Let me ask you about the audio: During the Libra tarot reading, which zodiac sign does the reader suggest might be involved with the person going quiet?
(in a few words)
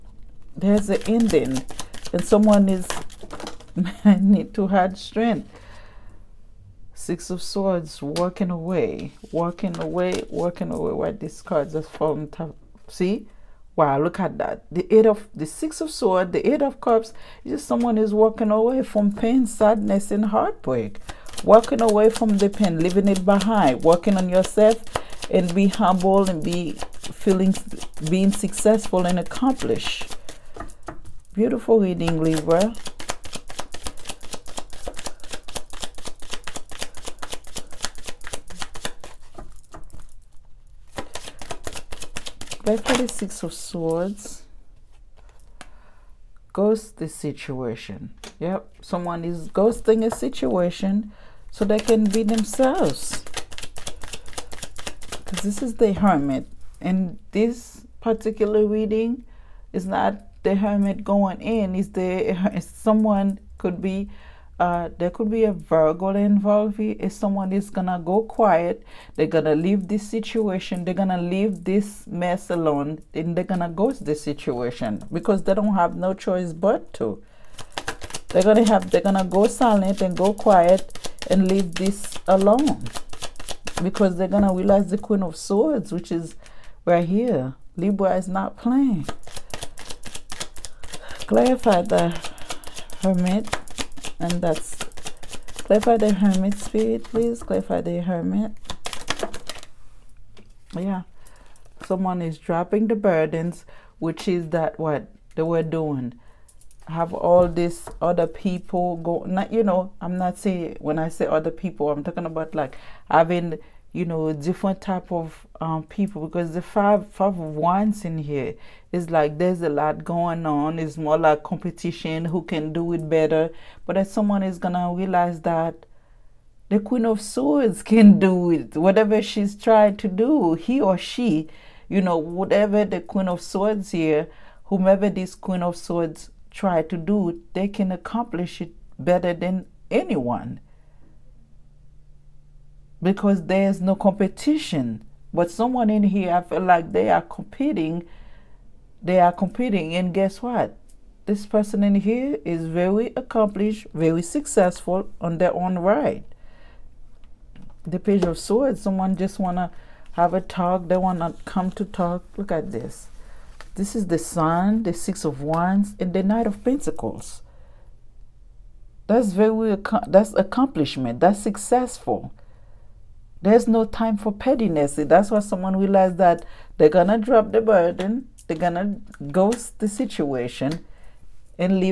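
Virgo.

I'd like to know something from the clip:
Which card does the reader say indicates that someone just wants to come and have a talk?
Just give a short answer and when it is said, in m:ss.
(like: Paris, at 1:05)
Page of Swords, at 2:37.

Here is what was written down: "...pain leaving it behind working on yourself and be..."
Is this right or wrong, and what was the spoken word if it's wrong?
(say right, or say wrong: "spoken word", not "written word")
right.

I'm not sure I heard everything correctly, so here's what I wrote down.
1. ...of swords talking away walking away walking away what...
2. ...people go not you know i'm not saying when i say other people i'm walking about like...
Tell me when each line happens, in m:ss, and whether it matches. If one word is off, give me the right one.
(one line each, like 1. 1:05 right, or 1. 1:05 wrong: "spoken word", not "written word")
1. 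0:07 wrong: "walking", not "talking"
2. 1:48 wrong: "talking", not "walking".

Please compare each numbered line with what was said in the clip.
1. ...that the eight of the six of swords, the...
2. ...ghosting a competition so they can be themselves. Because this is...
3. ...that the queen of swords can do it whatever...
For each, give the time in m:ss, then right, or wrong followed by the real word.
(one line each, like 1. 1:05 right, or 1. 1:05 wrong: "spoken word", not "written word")
1. 0:14 right
2. 0:49 wrong: "situation", not "competition"
3. 2:05 right.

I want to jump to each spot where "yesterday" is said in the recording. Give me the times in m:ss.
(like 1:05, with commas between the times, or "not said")
not said.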